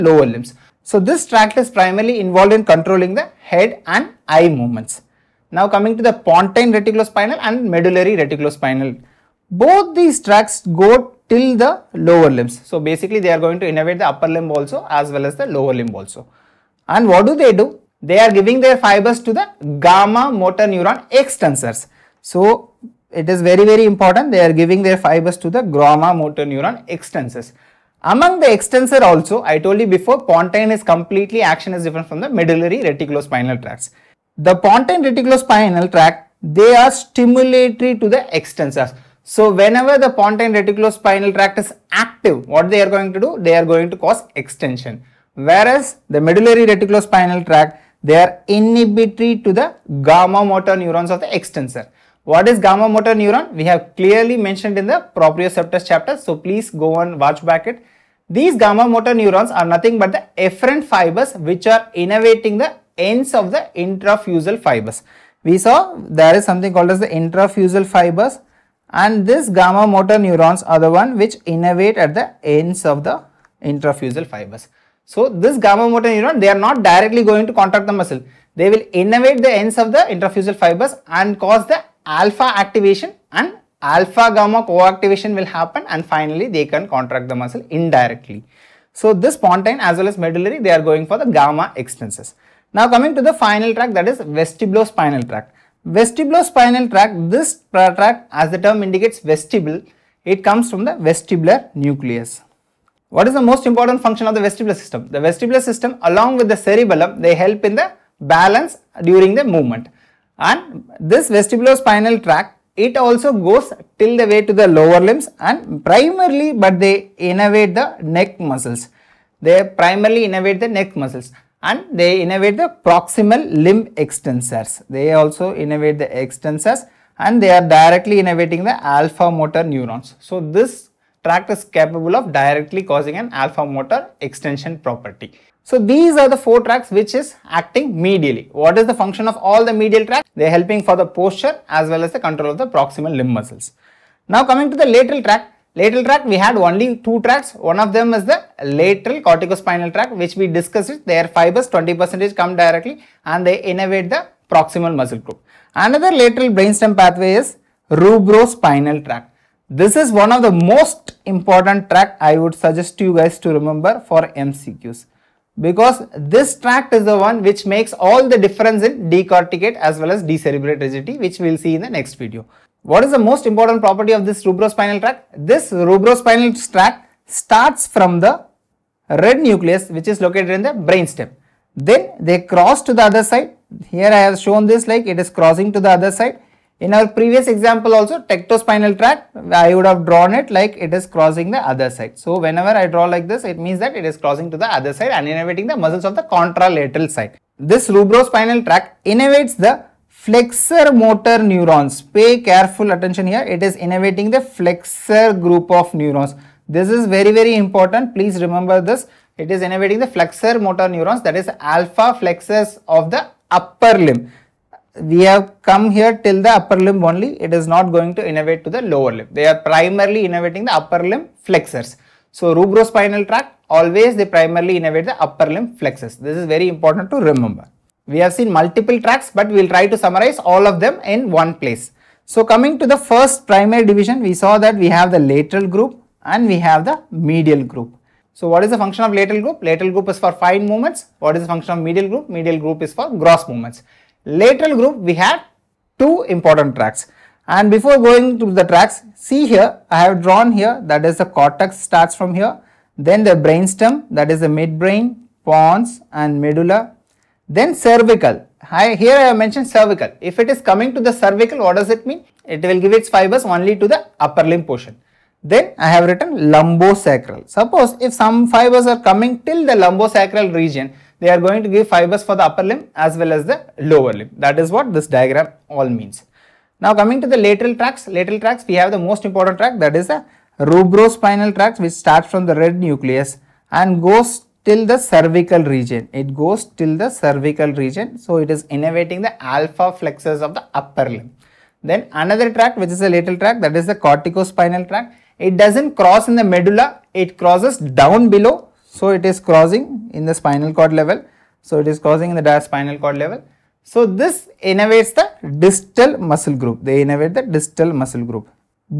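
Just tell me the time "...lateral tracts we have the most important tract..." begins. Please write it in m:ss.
4:38.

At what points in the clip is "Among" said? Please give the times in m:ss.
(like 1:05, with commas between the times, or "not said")
0:28.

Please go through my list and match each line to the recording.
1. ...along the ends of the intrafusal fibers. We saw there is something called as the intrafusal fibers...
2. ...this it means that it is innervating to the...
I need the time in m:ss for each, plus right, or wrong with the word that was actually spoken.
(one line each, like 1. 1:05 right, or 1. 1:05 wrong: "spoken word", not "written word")
1. 1:01 wrong: "innervating", not "along"
2. 3:13 wrong: "crossing", not "innervating".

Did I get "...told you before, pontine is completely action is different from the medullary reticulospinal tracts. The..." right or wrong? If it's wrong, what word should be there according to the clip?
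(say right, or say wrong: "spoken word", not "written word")
right.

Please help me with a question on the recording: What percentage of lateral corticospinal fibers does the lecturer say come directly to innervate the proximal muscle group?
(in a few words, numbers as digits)
20%.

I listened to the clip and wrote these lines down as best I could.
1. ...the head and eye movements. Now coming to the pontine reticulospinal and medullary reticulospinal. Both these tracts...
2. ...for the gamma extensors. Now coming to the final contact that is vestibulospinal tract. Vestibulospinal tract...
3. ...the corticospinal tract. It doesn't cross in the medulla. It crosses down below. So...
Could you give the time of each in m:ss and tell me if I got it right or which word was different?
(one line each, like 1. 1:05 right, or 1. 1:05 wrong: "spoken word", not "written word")
1. 0:03 right
2. 1:31 wrong: "tract", not "contact"
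3. 4:53 right.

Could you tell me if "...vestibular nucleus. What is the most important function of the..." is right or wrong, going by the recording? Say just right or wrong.
right.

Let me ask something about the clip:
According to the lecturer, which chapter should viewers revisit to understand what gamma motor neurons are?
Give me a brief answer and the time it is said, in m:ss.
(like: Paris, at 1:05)
Proprioceptors chapter, at 0:55.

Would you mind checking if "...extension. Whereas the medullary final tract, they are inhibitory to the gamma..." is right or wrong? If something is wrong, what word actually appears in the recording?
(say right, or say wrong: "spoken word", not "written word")
wrong: "reticulospinal", not "final".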